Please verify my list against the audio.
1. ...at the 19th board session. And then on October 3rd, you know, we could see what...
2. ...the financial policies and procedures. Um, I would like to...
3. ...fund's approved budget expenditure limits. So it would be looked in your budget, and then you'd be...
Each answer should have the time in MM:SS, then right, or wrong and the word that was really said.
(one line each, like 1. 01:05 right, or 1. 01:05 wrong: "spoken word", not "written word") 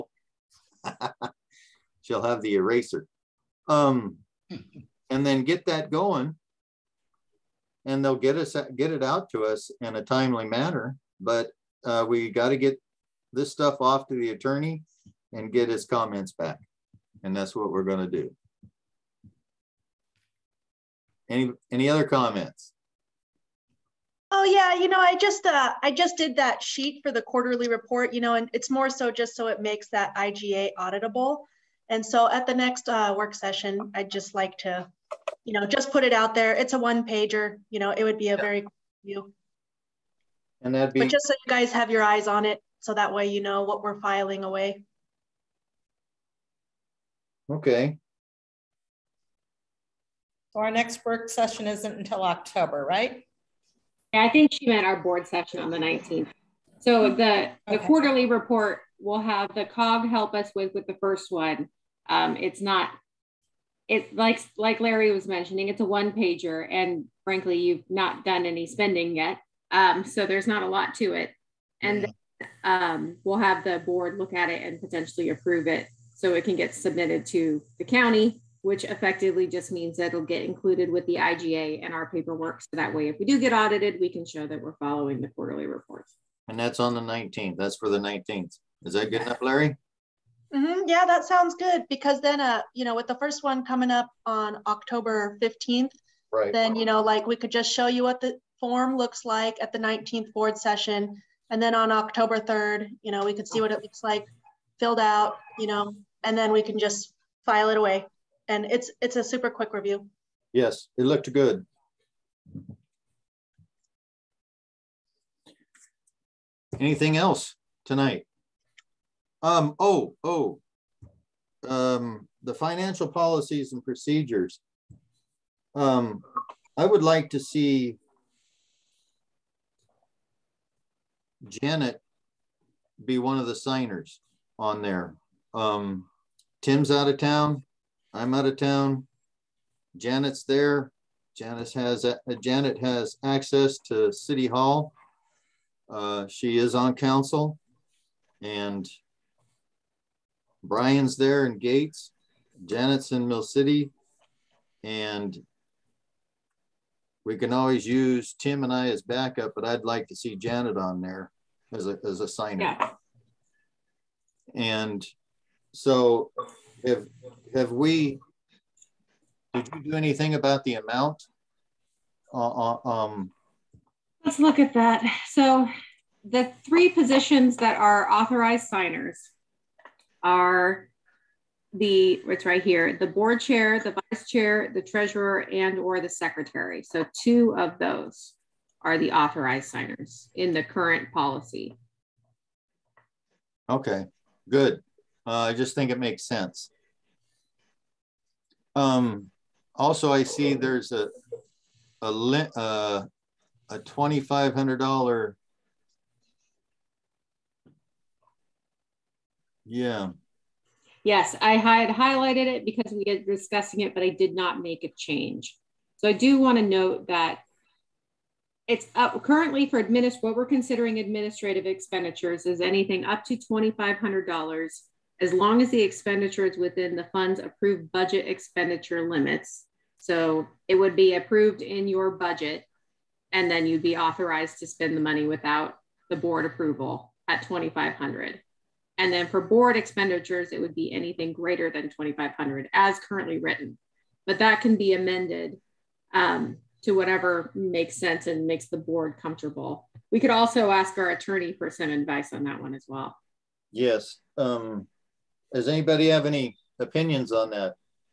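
1. 01:39 right
2. 02:02 right
3. 03:47 wrong: "approved", not "looked".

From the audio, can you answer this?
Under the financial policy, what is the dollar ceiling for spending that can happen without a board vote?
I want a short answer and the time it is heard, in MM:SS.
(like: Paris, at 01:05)
$2,500, at 03:43.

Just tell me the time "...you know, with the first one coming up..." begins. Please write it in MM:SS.
01:32.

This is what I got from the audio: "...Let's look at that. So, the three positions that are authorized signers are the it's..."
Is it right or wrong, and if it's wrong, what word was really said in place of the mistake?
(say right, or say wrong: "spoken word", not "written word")
right.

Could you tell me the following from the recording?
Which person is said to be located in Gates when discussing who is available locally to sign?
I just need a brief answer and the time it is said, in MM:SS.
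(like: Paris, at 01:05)
Brian, at 02:30.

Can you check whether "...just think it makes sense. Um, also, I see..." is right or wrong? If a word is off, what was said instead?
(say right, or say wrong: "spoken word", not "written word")
right.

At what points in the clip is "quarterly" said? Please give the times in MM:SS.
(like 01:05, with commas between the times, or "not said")
00:27, 00:57, 01:25.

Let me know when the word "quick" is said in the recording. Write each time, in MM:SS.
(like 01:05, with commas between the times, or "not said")
00:38, 01:49.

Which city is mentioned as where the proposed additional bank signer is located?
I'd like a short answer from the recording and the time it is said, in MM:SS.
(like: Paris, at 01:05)
Mill City, at 02:33.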